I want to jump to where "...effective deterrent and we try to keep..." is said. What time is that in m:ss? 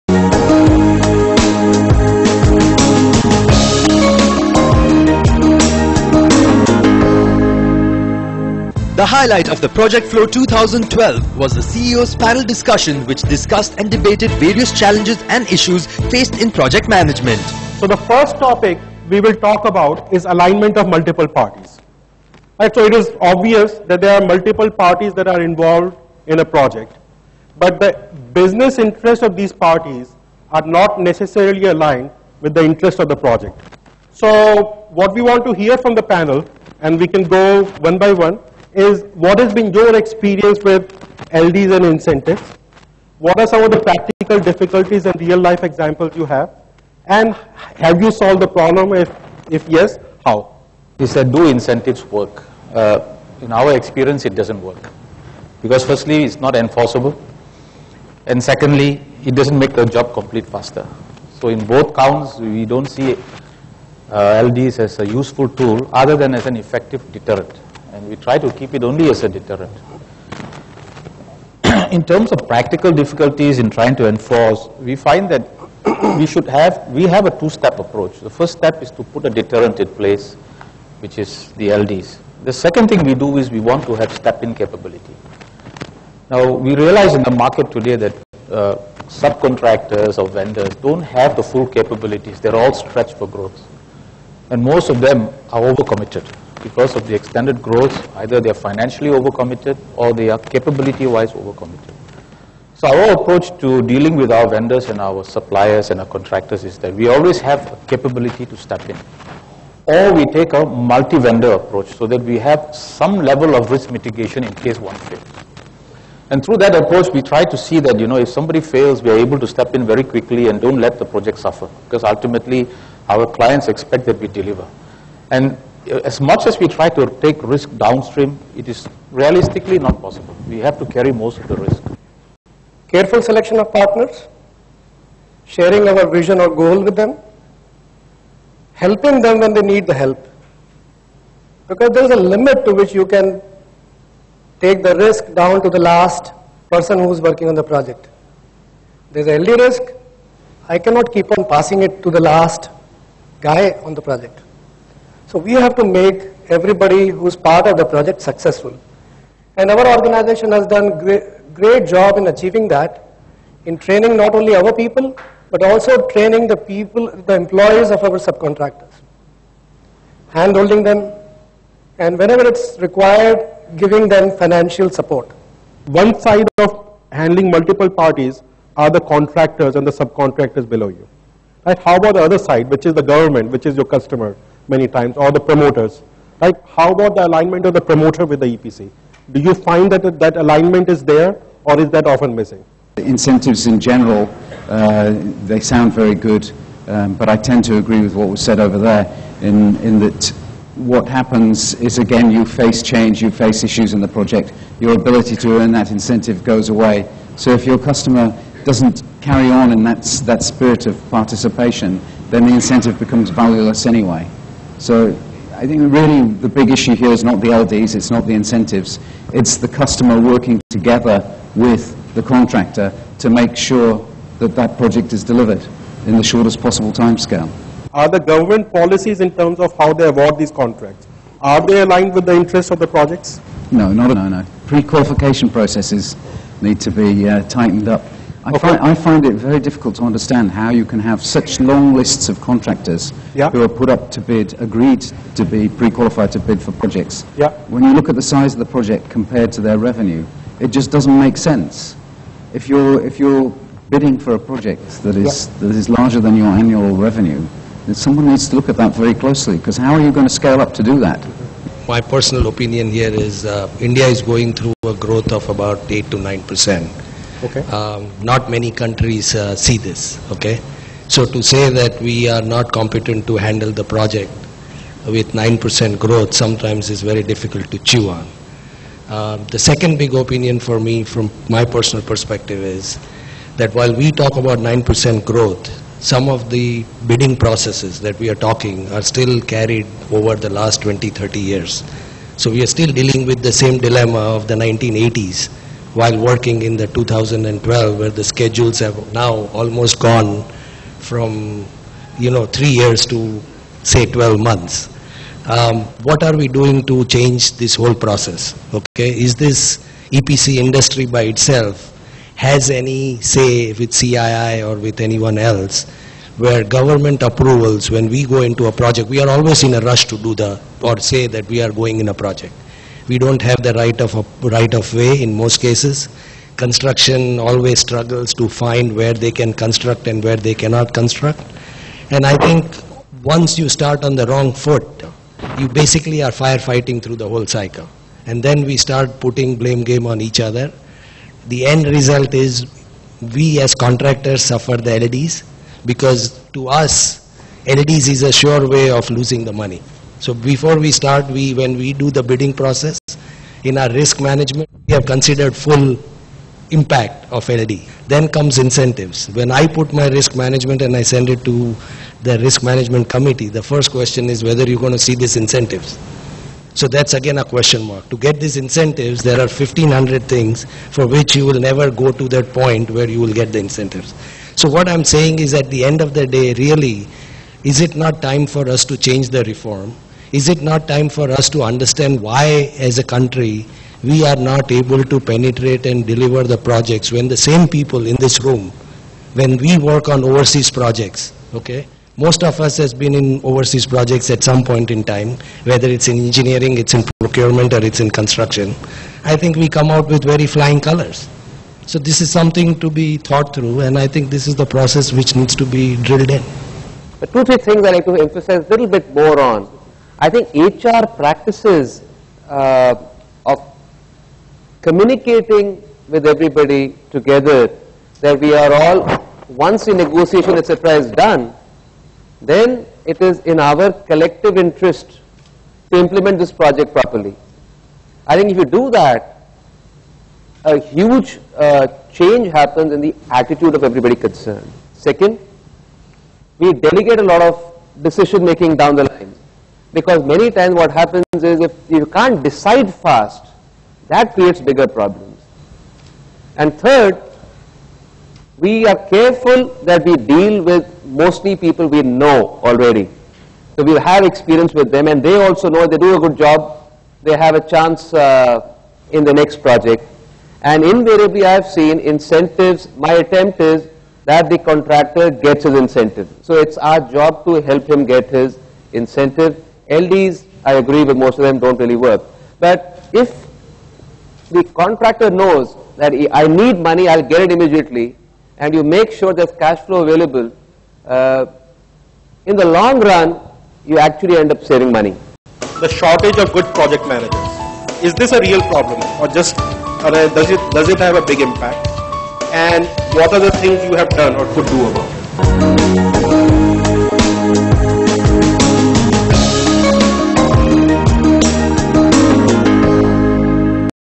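1:06.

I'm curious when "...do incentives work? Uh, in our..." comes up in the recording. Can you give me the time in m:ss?
0:51.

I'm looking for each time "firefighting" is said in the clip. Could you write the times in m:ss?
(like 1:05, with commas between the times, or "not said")
5:36.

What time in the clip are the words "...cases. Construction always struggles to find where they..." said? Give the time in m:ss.
5:25.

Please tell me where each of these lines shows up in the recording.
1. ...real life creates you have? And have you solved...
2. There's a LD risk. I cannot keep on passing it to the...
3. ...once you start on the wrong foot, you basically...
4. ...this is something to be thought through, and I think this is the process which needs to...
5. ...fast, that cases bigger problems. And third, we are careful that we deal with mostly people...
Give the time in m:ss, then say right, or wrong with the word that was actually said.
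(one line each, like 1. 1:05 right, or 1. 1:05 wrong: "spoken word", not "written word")
1. 0:45 wrong: "examples", not "creates"
2. 2:29 right
3. 5:33 right
4. 6:41 right
5. 7:22 wrong: "creates", not "cases".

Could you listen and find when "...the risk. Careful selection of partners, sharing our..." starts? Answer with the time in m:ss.
2:11.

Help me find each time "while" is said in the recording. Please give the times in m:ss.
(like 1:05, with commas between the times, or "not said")
4:43, 4:55.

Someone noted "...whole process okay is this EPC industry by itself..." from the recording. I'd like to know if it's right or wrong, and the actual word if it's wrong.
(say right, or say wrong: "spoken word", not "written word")
right.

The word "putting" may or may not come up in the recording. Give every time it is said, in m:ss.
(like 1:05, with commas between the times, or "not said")
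5:39.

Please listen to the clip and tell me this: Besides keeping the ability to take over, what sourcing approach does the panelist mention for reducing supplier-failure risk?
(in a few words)
Multi-vendor approach.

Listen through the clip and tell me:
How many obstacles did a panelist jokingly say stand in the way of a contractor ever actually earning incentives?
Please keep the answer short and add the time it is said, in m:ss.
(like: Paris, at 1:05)
1500, at 6:09.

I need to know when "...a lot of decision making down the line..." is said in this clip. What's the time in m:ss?
7:17.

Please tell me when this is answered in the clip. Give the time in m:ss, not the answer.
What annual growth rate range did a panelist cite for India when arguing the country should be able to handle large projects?
4:25.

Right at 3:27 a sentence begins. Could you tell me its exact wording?
So if your customer doesn't carry on in that, that spirit of participation, then the incentive becomes valueless anyway.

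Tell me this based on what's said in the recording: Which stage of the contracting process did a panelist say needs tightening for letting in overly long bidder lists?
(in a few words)
Pre-qualification processes.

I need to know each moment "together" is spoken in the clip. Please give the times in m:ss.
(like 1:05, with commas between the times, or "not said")
3:40, 6:57.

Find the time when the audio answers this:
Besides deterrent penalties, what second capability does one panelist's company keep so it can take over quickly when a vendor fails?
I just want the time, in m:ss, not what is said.
1:24.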